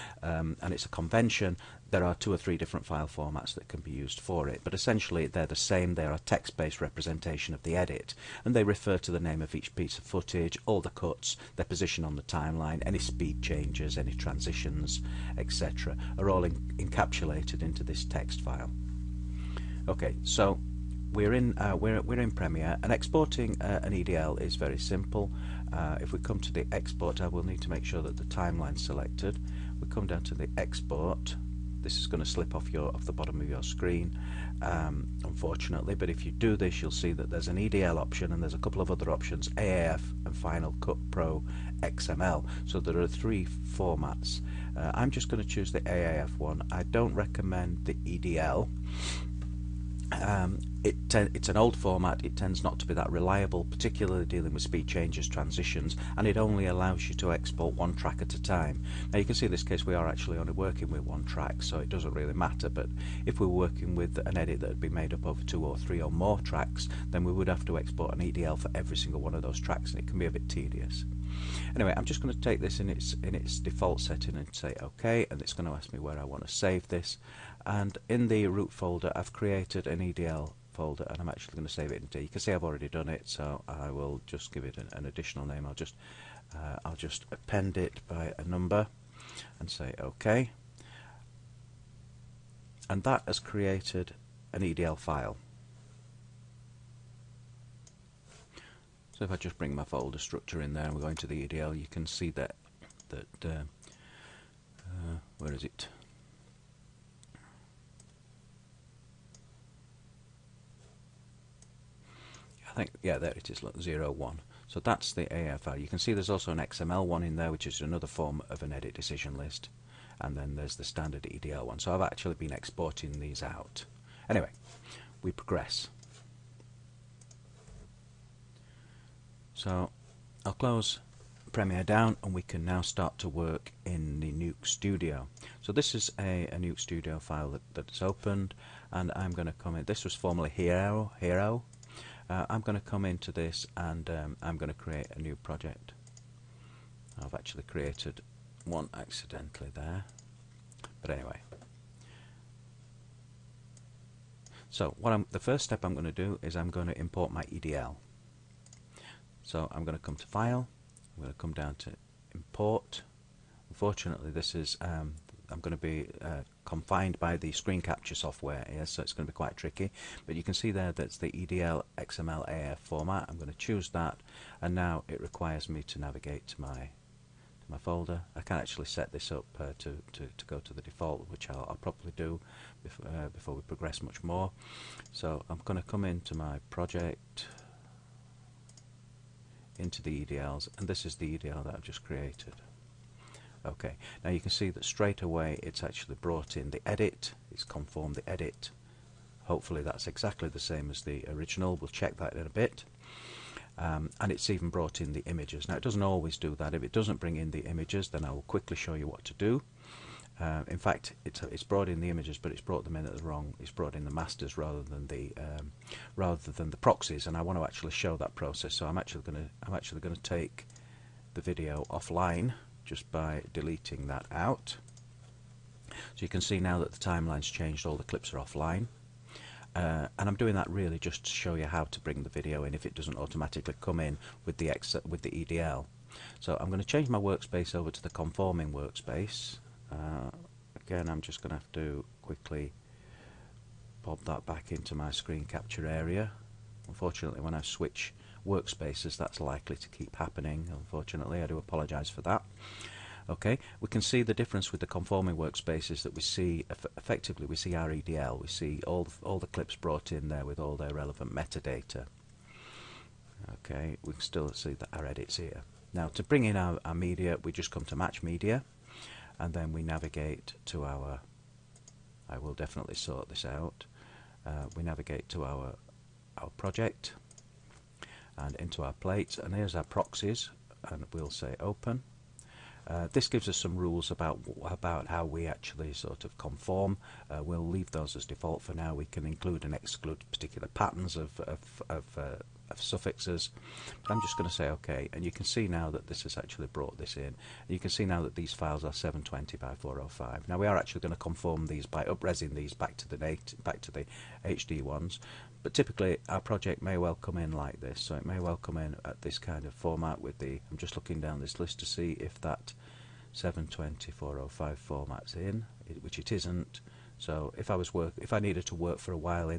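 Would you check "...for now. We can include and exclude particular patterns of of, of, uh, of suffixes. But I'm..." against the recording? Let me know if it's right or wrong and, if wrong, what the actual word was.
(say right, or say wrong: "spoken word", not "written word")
right.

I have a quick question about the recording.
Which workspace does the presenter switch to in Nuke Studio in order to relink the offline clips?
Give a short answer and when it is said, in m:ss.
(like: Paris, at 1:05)
conforming workspace, at 3:58.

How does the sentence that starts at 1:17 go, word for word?
And in the root folder, I've created an EDL folder and I'm actually going to save it D.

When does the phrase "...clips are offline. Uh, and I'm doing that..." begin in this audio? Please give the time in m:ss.
3:48.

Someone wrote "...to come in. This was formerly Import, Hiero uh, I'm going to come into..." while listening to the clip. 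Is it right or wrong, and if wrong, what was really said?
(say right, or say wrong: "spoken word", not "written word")
wrong: "Hiero", not "Import".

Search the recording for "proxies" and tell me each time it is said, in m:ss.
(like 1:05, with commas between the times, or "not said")
3:36, 4:39.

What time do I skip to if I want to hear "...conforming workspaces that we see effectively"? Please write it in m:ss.
4:14.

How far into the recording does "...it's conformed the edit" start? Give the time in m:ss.
3:17.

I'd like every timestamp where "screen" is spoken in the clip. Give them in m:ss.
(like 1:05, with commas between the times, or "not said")
0:33, 2:47, 4:05.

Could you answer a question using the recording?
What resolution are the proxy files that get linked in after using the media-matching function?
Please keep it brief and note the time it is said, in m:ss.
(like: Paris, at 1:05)
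720 by 405, at 4:58.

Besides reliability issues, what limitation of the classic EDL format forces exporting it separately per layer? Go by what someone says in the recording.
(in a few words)
one track at a time.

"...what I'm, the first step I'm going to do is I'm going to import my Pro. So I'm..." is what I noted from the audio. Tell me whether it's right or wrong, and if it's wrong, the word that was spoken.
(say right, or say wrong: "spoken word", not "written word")
wrong: "EDL", not "Pro".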